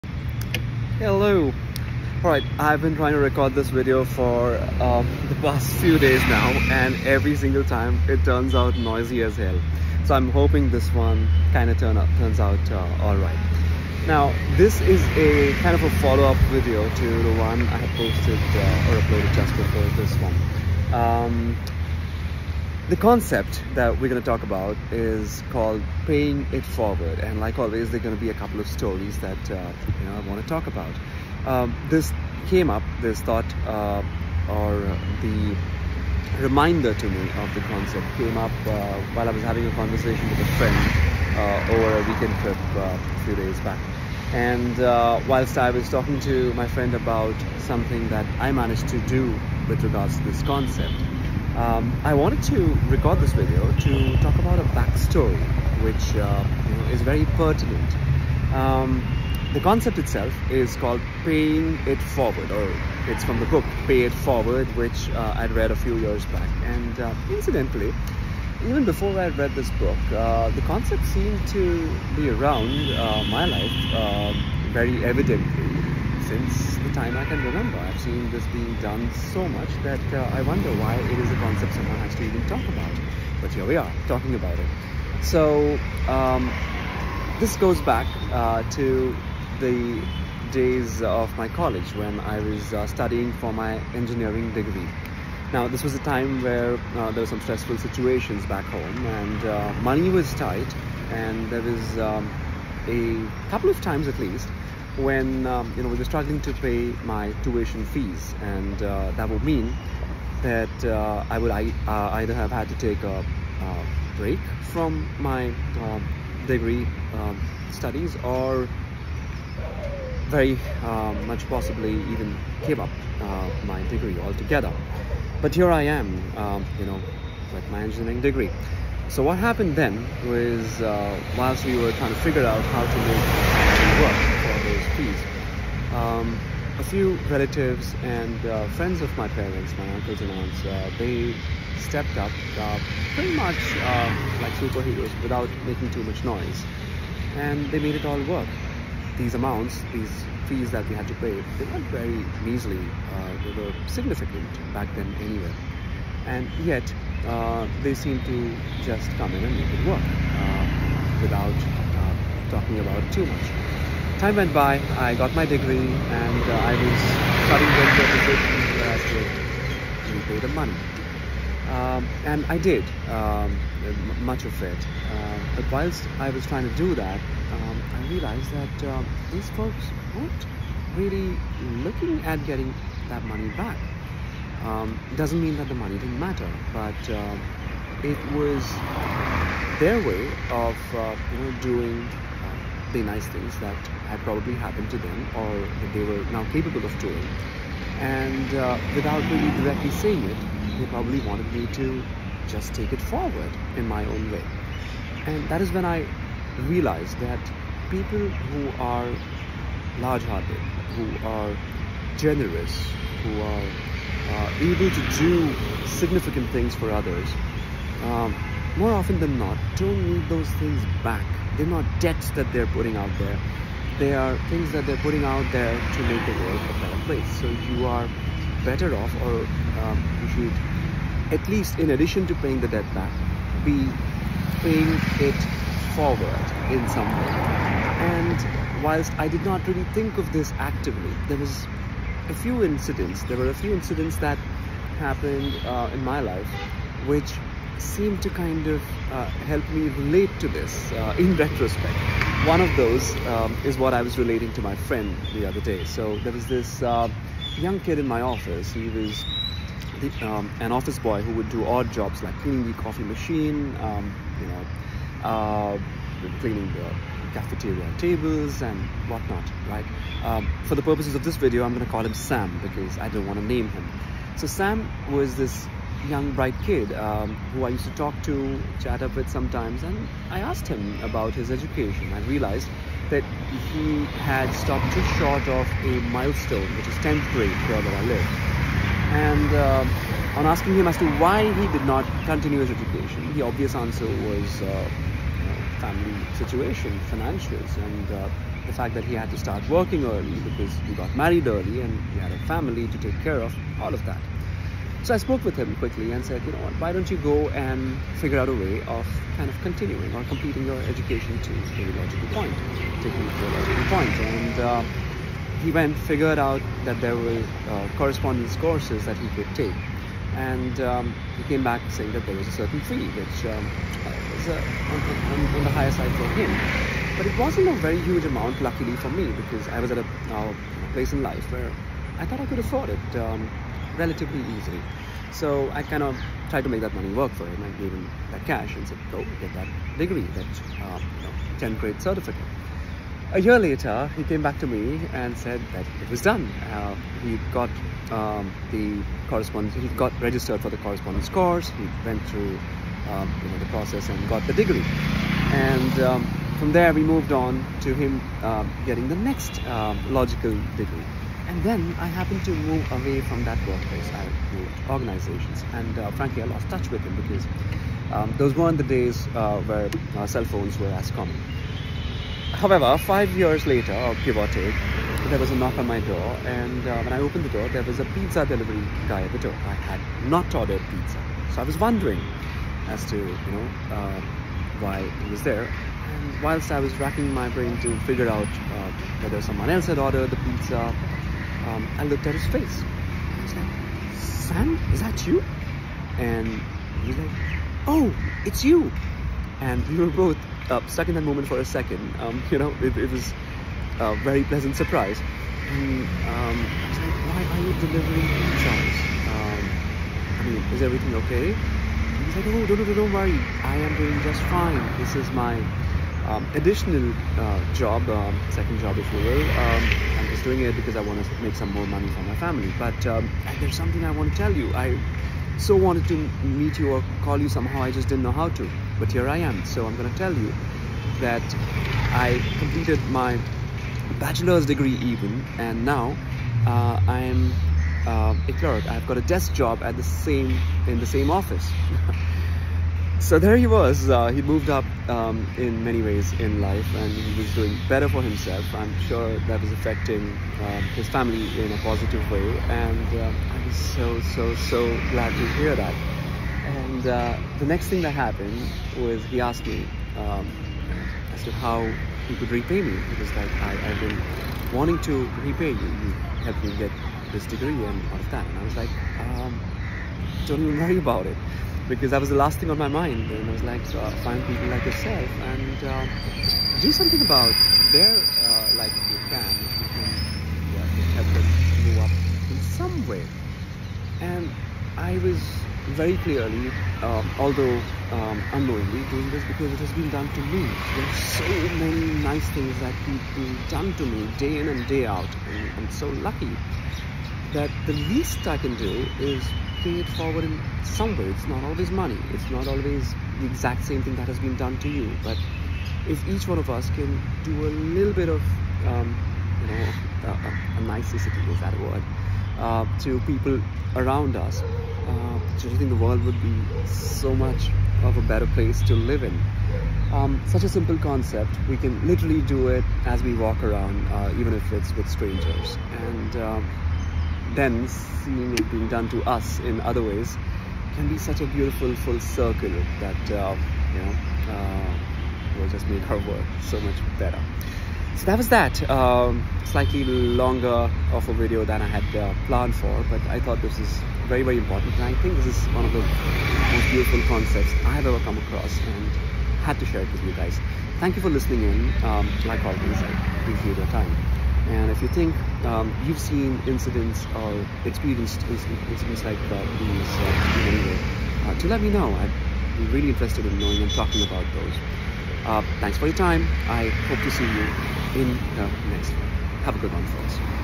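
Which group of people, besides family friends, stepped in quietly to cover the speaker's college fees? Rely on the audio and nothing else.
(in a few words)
uncles and aunts.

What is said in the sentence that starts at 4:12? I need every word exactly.
One of those um, is what I was relating to my friend the other day.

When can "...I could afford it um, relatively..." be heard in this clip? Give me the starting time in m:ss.
5:32.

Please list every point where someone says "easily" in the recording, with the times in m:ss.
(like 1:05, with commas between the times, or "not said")
5:34.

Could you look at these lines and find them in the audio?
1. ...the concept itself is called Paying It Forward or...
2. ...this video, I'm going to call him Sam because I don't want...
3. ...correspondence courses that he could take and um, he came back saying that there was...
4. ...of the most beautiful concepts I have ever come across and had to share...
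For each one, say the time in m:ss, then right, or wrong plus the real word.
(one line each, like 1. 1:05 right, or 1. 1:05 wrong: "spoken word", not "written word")
1. 0:59 right
2. 4:31 right
3. 5:17 right
4. 9:05 right.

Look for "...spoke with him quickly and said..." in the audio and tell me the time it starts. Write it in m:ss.
5:05.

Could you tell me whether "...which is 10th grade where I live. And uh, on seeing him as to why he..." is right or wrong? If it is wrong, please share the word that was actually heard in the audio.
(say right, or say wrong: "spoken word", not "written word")
wrong: "asking", not "seeing".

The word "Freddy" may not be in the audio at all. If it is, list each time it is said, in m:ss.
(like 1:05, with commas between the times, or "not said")
not said.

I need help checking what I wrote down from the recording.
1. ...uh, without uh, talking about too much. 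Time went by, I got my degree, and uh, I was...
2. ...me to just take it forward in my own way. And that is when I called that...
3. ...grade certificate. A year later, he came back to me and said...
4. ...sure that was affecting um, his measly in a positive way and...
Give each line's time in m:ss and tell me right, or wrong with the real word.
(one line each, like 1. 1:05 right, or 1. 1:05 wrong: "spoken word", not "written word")
1. 2:40 right
2. 3:21 wrong: "realized", not "called"
3. 5:41 right
4. 7:29 wrong: "family", not "measly".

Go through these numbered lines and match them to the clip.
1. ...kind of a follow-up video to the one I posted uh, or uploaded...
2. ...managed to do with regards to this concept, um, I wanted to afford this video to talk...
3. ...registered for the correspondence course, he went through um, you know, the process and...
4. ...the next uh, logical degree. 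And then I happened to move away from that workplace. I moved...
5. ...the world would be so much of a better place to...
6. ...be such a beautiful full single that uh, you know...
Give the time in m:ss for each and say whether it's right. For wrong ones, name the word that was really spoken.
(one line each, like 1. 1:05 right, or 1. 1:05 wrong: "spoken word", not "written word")
1. 0:15 right
2. 0:48 wrong: "record", not "afford"
3. 5:50 right
4. 5:59 right
5. 8:35 right
6. 8:51 wrong: "circle", not "single".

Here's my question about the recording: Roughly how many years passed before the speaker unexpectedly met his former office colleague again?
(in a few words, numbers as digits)
5.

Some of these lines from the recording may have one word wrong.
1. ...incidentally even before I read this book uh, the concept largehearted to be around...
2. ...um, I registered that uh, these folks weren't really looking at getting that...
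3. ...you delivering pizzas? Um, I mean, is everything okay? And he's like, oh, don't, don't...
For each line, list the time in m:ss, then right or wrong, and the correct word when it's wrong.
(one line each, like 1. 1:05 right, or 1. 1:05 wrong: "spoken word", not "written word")
1. 1:07 wrong: "seemed", not "largehearted"
2. 2:57 wrong: "realized", not "registered"
3. 6:47 right.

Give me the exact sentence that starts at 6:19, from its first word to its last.
I had not ordered pizza, so I was wondering as to you know uh, why he was there.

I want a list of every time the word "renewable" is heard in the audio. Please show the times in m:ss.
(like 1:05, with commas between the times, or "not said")
not said.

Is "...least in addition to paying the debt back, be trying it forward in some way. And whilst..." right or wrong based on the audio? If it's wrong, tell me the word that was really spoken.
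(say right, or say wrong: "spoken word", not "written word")
wrong: "paying", not "trying".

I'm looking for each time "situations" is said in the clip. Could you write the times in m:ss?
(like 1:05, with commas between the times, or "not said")
1:37, 4:56.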